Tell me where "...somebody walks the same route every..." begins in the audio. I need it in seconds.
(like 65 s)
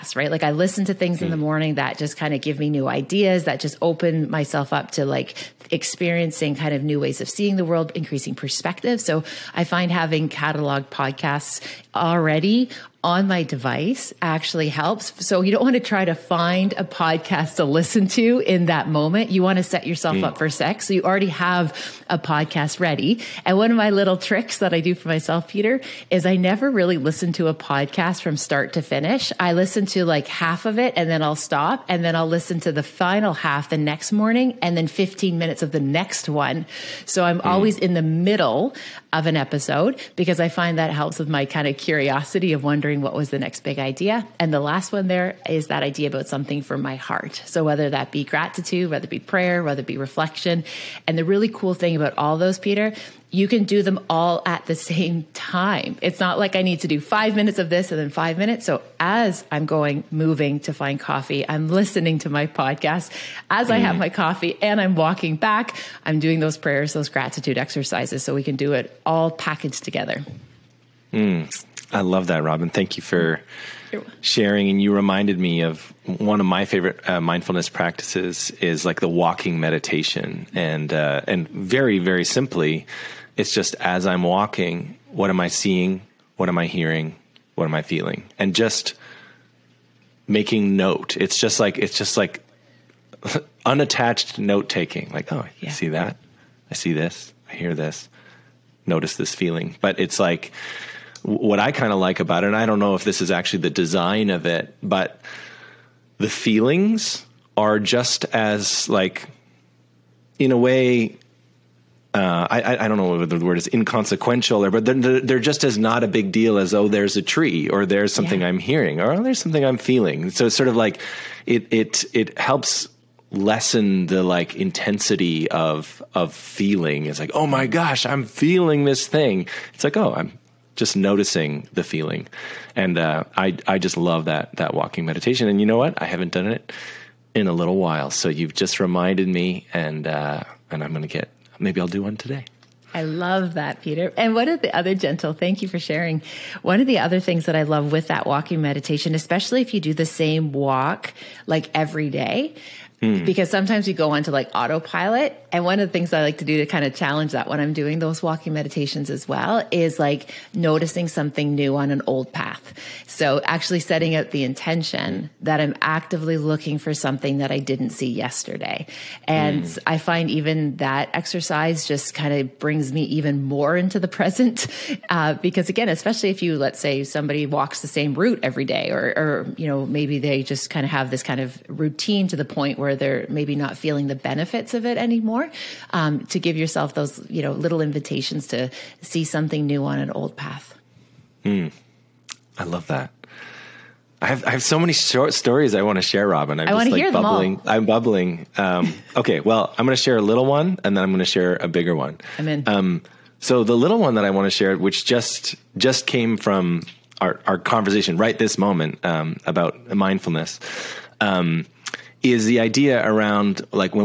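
177 s.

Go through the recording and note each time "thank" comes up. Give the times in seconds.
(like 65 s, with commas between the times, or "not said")
72 s, 145 s.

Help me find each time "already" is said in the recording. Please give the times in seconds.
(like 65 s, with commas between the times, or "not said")
11 s, 21 s.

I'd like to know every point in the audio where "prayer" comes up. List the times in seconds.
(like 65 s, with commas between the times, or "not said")
49 s, 66 s.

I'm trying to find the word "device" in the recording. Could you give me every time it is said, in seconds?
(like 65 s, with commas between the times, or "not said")
13 s.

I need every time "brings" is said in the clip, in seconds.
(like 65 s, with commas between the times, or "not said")
172 s.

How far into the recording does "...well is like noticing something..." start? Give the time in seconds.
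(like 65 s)
159 s.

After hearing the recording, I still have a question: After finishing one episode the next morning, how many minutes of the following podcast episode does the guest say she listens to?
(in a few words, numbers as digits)
15 minutes.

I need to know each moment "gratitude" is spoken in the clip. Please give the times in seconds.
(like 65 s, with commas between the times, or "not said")
48 s, 67 s.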